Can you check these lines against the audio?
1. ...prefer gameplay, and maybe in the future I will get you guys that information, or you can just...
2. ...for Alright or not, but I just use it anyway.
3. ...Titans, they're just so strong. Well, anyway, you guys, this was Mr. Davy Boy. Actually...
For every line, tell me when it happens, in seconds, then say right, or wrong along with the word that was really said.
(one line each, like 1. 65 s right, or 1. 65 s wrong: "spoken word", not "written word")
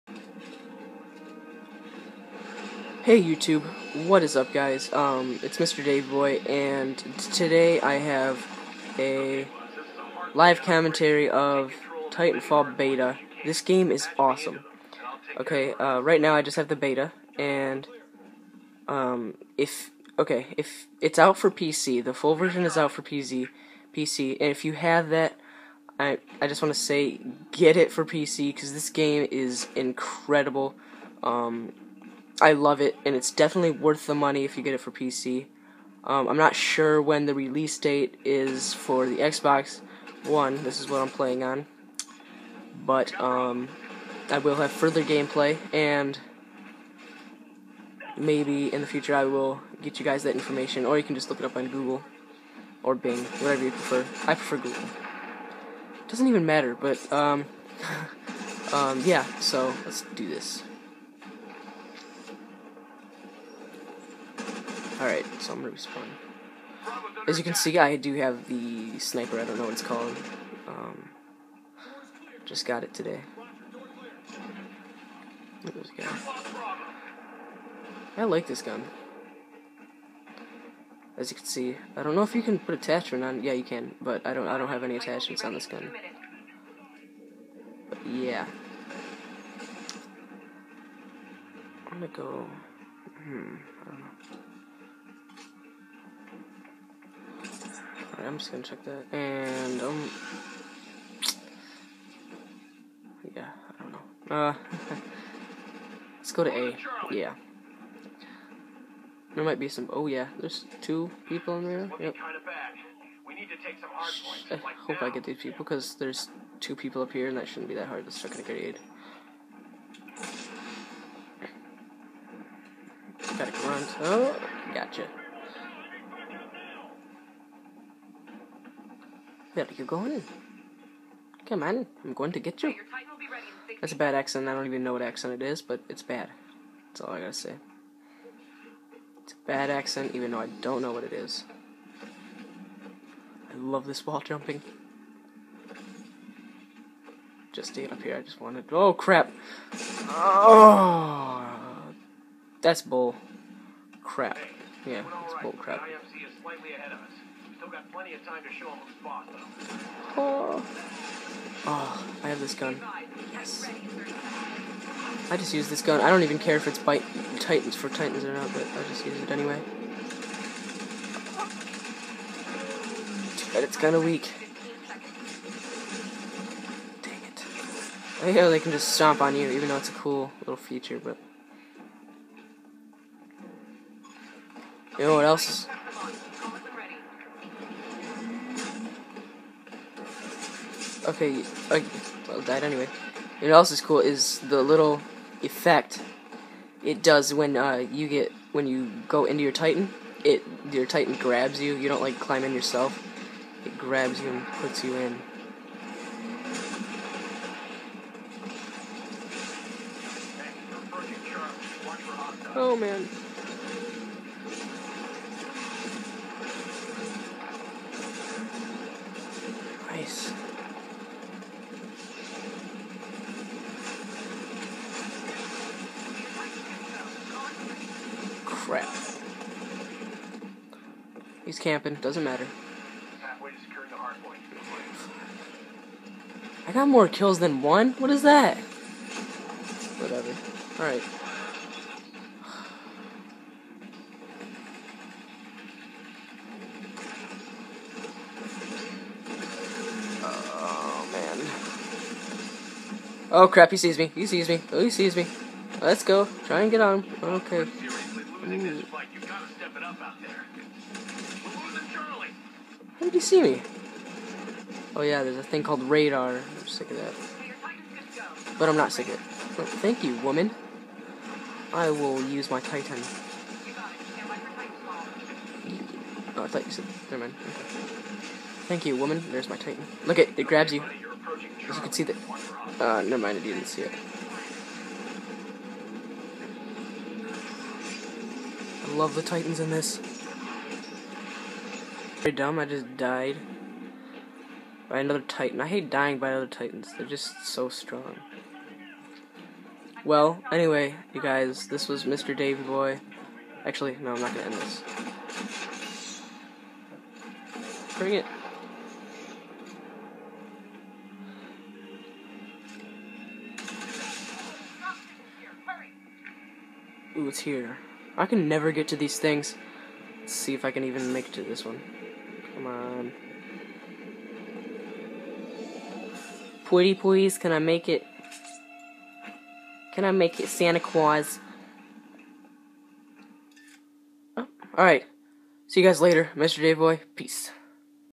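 1. 44 s wrong: "further", not "prefer"
2. 167 s wrong: "Titans", not "Alright"
3. 296 s right.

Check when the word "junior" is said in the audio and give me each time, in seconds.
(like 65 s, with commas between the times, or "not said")
not said.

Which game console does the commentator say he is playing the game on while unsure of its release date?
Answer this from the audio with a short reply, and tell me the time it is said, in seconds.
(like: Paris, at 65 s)
Xbox One, at 39 s.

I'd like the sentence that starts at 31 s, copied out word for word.
Um, I love it, and it's definitely worth the money if you get it for PC.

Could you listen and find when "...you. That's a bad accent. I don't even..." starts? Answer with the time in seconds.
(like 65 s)
132 s.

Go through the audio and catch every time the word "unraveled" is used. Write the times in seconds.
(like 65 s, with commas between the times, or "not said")
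not said.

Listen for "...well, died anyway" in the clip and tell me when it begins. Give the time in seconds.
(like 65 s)
192 s.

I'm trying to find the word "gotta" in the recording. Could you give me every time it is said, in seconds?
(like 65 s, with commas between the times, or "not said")
123 s, 137 s.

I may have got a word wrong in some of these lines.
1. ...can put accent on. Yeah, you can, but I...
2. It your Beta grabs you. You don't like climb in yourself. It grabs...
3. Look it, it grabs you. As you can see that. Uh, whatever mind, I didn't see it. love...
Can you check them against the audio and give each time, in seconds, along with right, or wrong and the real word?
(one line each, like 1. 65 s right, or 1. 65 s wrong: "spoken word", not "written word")
1. 82 s wrong: "attachment", not "accent"
2. 200 s wrong: "Titan", not "Beta"
3. 280 s wrong: "never", not "whatever".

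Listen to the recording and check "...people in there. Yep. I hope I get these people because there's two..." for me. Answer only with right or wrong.
right.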